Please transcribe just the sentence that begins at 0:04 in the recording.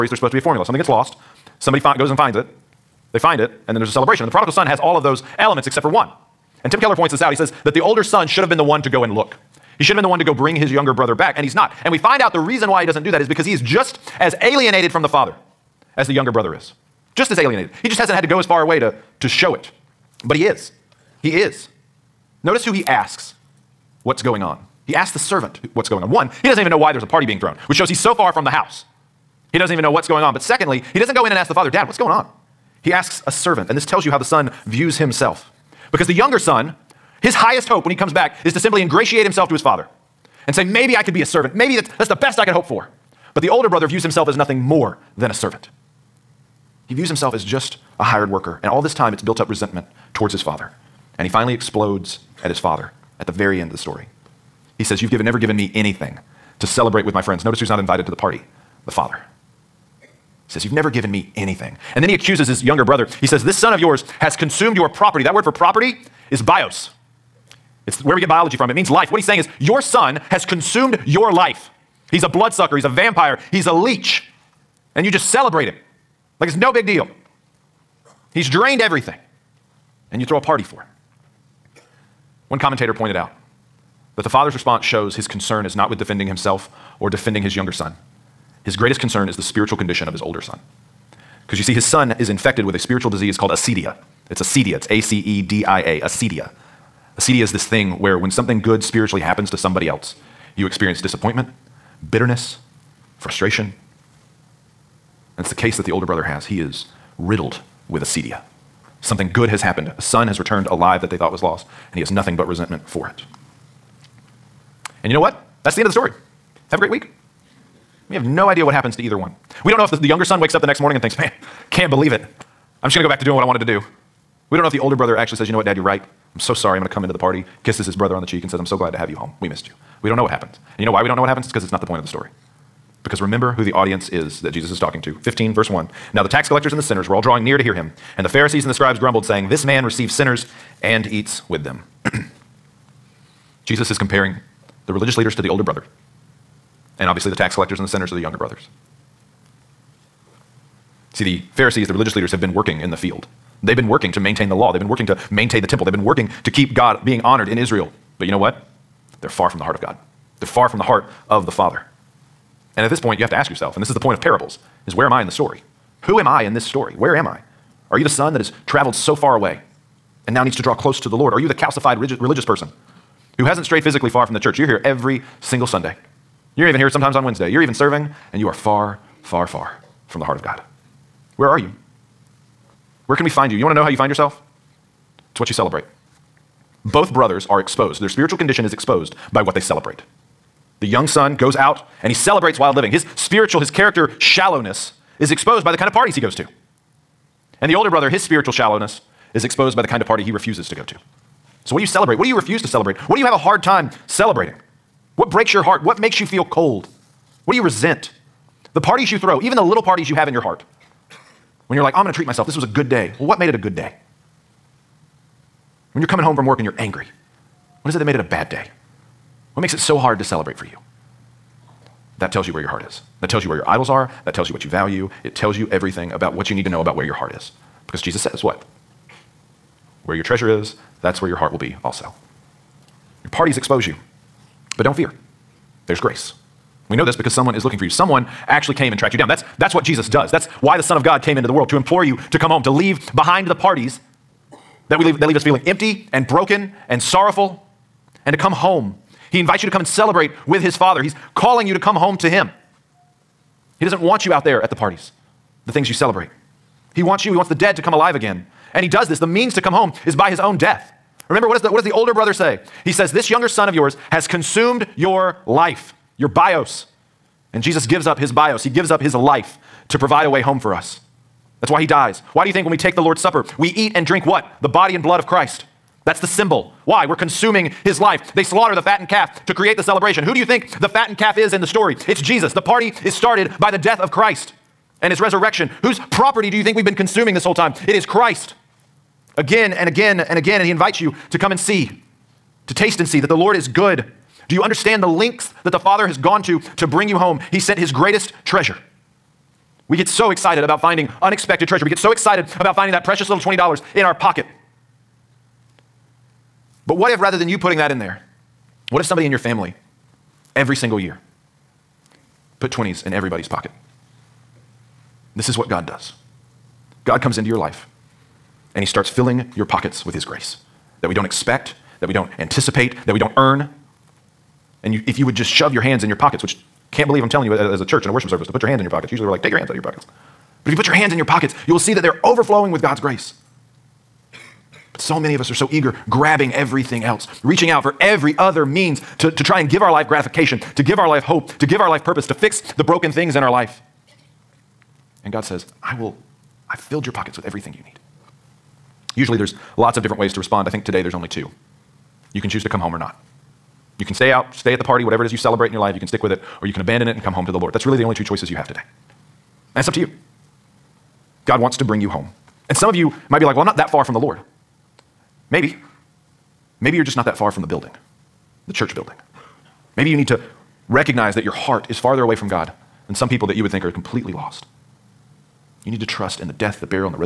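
And the prodigal son has all of those elements except for one.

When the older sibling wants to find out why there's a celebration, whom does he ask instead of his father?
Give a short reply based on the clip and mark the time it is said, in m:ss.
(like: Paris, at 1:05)
The servant, at 0:25.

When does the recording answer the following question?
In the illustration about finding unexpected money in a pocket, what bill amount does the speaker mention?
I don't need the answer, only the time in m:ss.
5:03.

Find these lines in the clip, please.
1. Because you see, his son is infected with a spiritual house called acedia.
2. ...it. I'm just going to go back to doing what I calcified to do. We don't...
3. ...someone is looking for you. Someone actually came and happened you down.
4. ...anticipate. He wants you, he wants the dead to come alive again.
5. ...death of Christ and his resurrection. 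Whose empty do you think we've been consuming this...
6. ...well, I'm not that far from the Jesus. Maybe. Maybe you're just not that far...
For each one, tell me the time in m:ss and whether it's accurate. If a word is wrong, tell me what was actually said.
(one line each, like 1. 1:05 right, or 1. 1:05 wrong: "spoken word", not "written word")
1. 1:31 wrong: "disease", not "house"
2. 2:02 wrong: "wanted", not "calcified"
3. 3:57 wrong: "tracked", not "happened"
4. 4:15 wrong: "celebrate", not "anticipate"
5. 4:43 wrong: "property", not "empty"
6. 6:03 wrong: "Lord", not "Jesus".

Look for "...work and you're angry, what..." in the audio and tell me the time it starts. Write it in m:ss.
3:36.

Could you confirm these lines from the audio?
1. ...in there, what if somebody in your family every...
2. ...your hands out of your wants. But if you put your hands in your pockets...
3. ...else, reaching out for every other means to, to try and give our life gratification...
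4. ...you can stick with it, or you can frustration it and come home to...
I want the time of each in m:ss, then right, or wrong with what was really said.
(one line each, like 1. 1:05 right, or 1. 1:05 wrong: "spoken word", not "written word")
1. 5:07 right
2. 5:29 wrong: "pockets", not "wants"
3. 5:37 right
4. 5:55 wrong: "abandon", not "frustration".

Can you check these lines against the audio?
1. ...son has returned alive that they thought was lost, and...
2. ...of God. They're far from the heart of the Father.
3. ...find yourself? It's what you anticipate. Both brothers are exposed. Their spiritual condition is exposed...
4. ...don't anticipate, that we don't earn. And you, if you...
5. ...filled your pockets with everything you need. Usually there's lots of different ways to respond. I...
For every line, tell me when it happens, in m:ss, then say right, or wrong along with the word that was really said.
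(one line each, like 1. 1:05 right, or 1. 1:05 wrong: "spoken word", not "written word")
1. 1:50 right
2. 2:39 right
3. 3:03 wrong: "celebrate", not "anticipate"
4. 5:22 right
5. 5:46 right.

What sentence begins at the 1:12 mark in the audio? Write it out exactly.
He's a bloodsucker, he's a vampire, he's a leech and you just celebrate him like it's no big deal.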